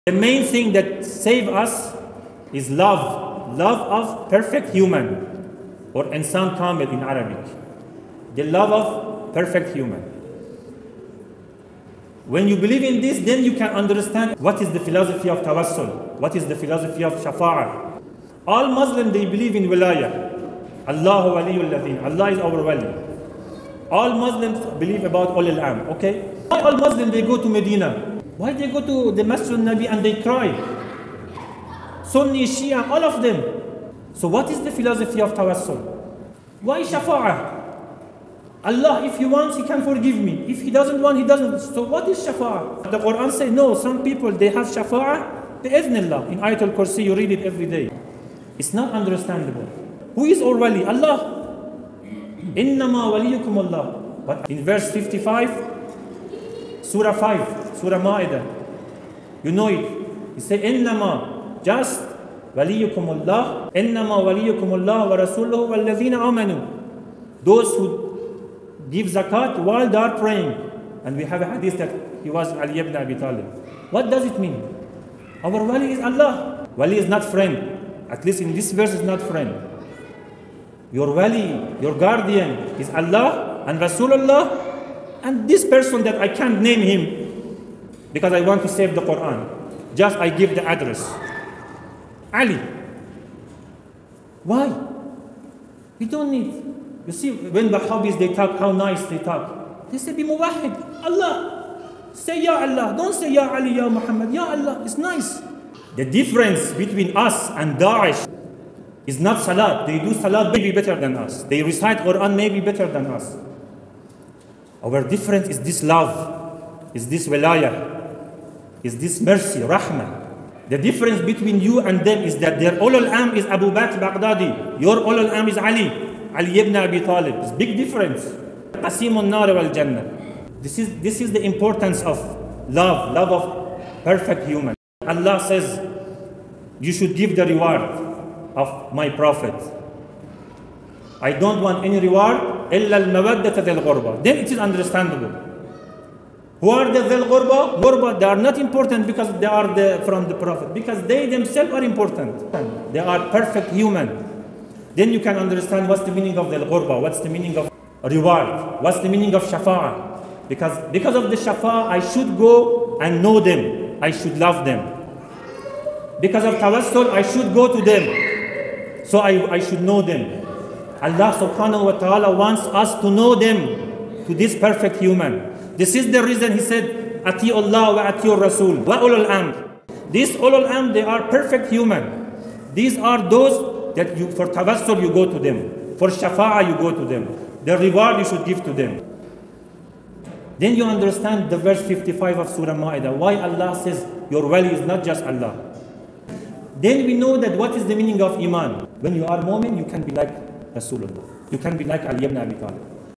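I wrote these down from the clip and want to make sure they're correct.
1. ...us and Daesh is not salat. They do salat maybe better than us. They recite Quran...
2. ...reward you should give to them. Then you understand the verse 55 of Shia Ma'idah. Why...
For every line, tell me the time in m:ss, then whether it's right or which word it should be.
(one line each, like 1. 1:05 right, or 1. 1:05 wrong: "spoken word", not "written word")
1. 1:47 right
2. 3:07 wrong: "Surah", not "Shia".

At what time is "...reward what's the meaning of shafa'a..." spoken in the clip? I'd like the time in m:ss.
2:38.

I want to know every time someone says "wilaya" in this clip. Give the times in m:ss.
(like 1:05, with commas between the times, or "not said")
0:19, 1:57.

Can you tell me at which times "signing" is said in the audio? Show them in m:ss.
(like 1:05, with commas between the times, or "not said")
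not said.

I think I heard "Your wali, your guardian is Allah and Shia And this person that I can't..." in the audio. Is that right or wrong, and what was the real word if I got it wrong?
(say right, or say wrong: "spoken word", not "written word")
wrong: "Rasulullah", not "Shia".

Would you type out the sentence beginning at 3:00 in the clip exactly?
These ulul amr, they are perfect human.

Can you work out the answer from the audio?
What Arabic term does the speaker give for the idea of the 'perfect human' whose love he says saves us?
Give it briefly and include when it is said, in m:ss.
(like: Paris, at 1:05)
insan kamil, at 0:06.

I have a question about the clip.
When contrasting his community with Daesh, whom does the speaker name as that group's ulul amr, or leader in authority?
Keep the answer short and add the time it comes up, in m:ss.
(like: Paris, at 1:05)
Abu Bakr Baghdadi, at 2:03.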